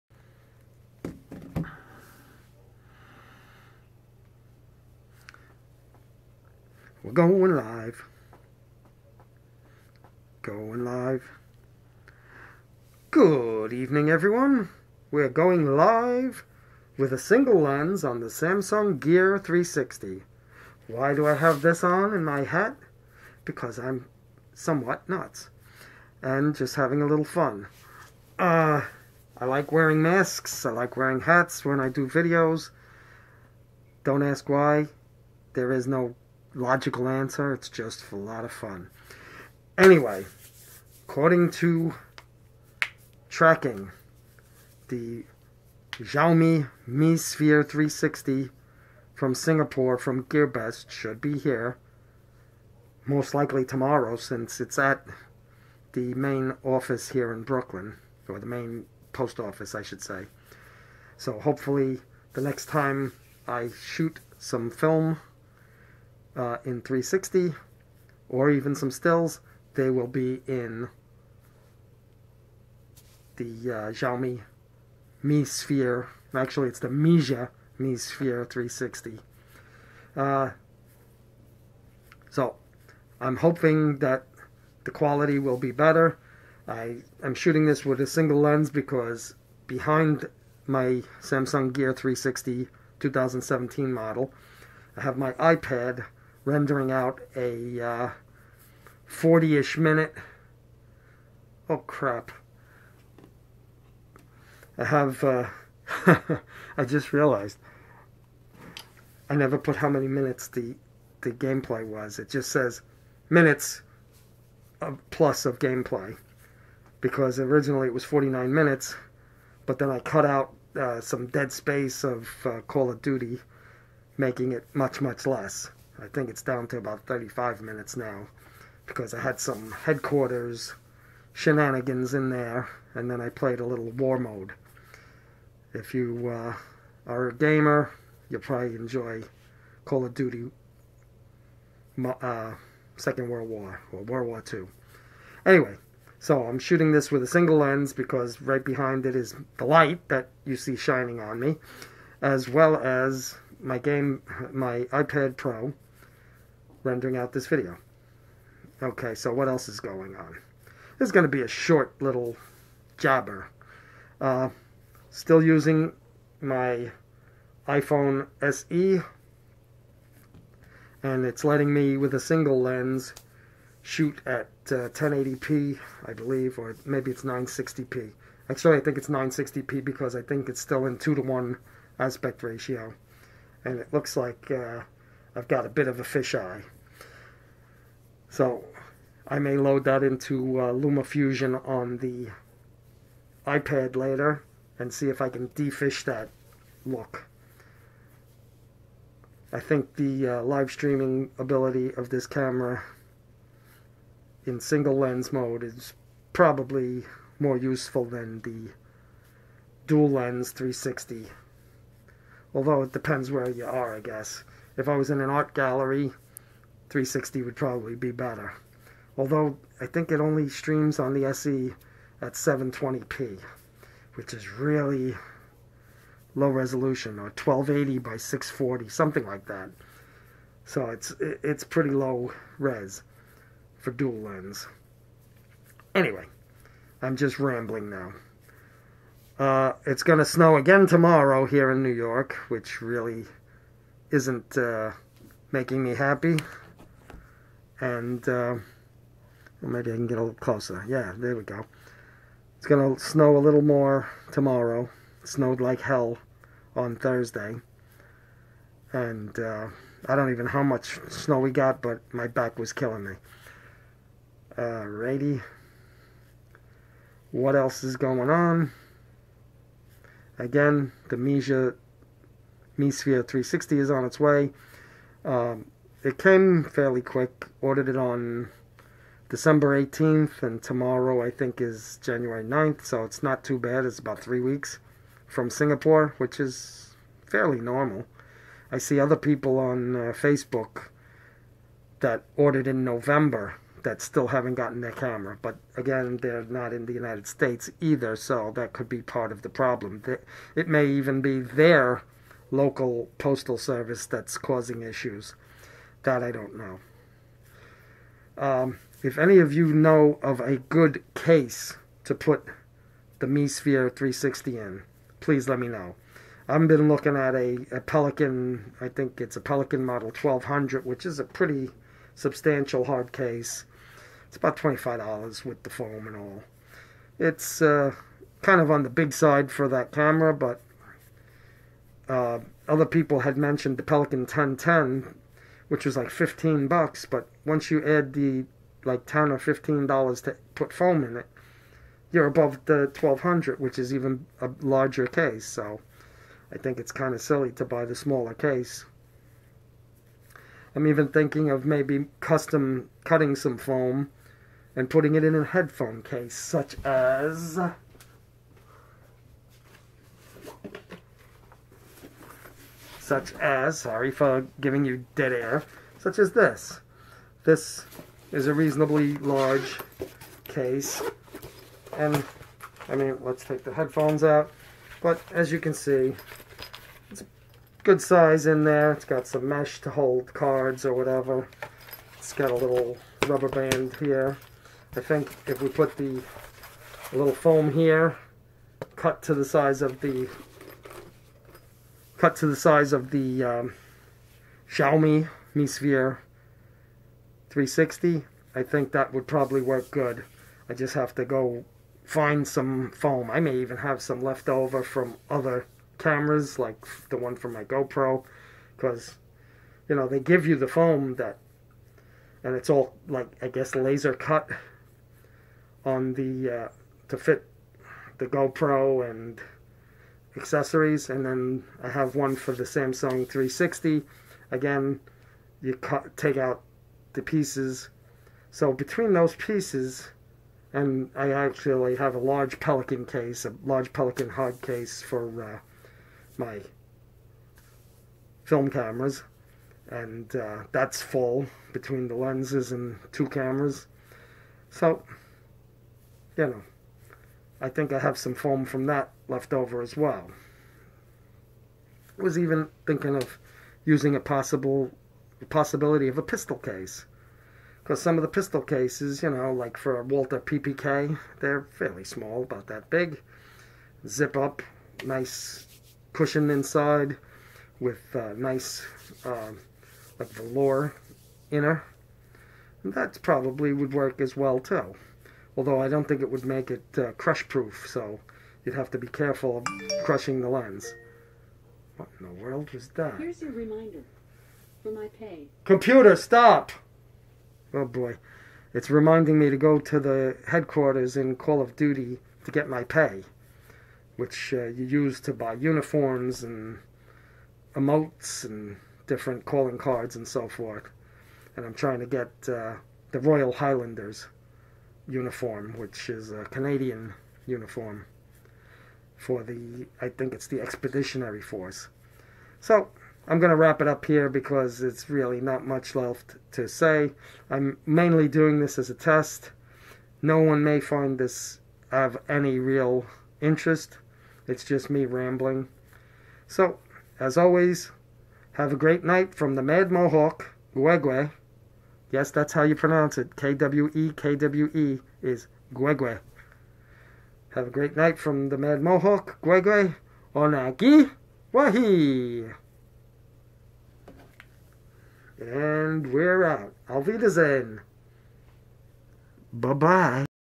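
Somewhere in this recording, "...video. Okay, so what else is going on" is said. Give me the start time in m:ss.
2:37.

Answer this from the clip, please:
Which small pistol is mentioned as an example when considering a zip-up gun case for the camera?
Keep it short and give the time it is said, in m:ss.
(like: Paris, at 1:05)
Walther PPK, at 7:40.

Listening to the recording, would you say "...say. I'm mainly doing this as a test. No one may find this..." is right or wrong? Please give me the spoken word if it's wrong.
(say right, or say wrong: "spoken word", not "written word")
right.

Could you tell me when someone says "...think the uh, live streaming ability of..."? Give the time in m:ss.
3:19.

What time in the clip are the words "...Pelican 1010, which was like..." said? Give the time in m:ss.
5:33.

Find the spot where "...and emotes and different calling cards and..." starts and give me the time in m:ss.
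8:16.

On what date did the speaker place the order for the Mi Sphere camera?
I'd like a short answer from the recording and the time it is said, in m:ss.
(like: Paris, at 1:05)
December 18th, at 4:39.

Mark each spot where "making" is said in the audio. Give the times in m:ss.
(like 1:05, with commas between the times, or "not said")
2:04, 4:05.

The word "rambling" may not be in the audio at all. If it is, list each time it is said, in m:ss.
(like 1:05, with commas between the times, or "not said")
3:57, 8:45.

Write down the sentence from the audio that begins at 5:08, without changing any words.
Um, if any of you know of a good case to put the Mi Sphere 360 in, please let me know.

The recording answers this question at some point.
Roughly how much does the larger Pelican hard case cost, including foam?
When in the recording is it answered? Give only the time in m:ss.
5:24.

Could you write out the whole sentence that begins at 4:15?
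It snowed like hell on Thursday.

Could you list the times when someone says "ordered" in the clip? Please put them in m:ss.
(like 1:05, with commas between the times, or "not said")
4:37, 4:52.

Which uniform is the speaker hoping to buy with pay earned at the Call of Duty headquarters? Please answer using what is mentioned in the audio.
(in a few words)
Royal Highlanders.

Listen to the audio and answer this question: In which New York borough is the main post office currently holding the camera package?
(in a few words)
Brooklyn.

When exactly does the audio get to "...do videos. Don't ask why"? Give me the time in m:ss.
0:31.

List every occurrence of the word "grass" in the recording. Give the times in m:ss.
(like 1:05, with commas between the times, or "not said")
not said.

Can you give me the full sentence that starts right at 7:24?
So, you know, I think I have some foam from that left over as well.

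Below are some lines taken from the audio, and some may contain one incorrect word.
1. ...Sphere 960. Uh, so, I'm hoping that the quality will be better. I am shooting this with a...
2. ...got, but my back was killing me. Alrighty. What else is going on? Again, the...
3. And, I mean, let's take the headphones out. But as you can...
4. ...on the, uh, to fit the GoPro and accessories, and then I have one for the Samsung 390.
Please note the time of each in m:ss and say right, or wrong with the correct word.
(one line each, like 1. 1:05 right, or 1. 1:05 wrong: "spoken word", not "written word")
1. 1:17 wrong: "360", not "960"
2. 4:21 right
3. 6:11 right
4. 6:55 wrong: "360", not "390".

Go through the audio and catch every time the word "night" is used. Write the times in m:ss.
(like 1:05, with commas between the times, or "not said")
8:49, 8:57.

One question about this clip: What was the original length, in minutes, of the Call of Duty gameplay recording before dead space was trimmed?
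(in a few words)
49.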